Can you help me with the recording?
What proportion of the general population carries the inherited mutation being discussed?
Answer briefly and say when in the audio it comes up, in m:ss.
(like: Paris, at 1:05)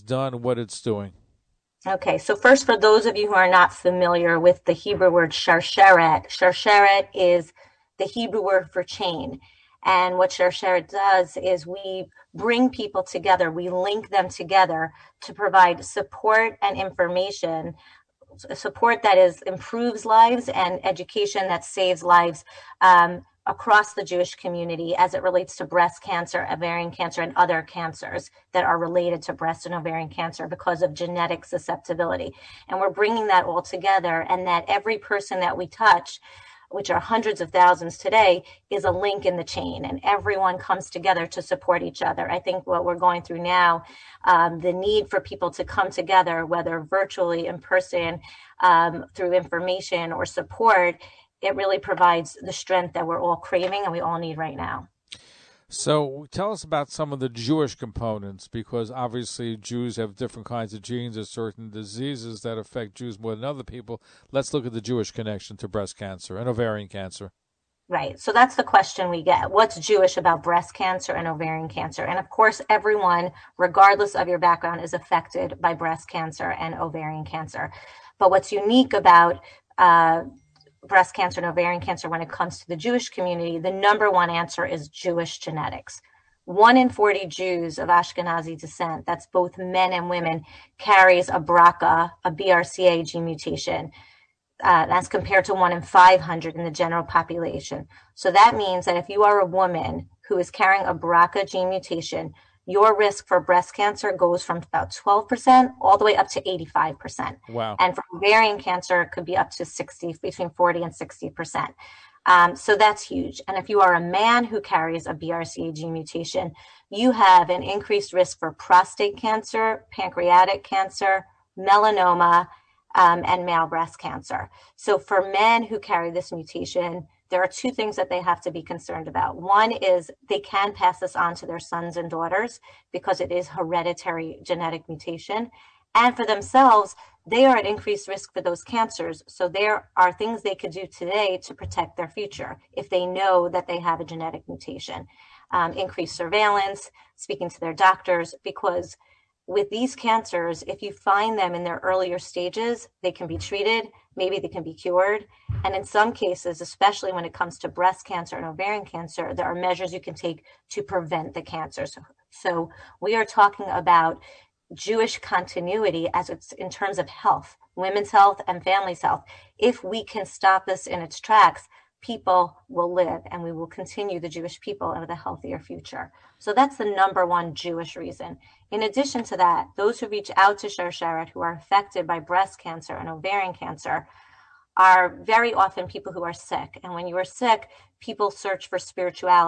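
1 in 500, at 1:35.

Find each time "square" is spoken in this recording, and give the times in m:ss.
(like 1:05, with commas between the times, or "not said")
not said.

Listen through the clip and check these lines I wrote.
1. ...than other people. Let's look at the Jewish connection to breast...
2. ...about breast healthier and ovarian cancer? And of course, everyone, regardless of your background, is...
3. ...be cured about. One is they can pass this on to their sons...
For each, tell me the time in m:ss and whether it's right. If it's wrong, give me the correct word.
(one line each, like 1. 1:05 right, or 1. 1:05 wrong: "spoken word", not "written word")
1. 1:03 right
2. 1:10 wrong: "cancer", not "healthier"
3. 2:08 wrong: "concerned", not "cured".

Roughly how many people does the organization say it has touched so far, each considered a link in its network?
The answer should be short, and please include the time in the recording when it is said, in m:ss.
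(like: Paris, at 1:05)
Hundreds of thousands, at 0:36.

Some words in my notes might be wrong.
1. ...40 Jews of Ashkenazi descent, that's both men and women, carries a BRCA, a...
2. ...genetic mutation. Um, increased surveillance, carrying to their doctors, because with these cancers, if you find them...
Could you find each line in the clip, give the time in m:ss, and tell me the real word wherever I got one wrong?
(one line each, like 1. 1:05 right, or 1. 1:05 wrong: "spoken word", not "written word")
1. 1:26 right
2. 2:24 wrong: "speaking", not "carrying".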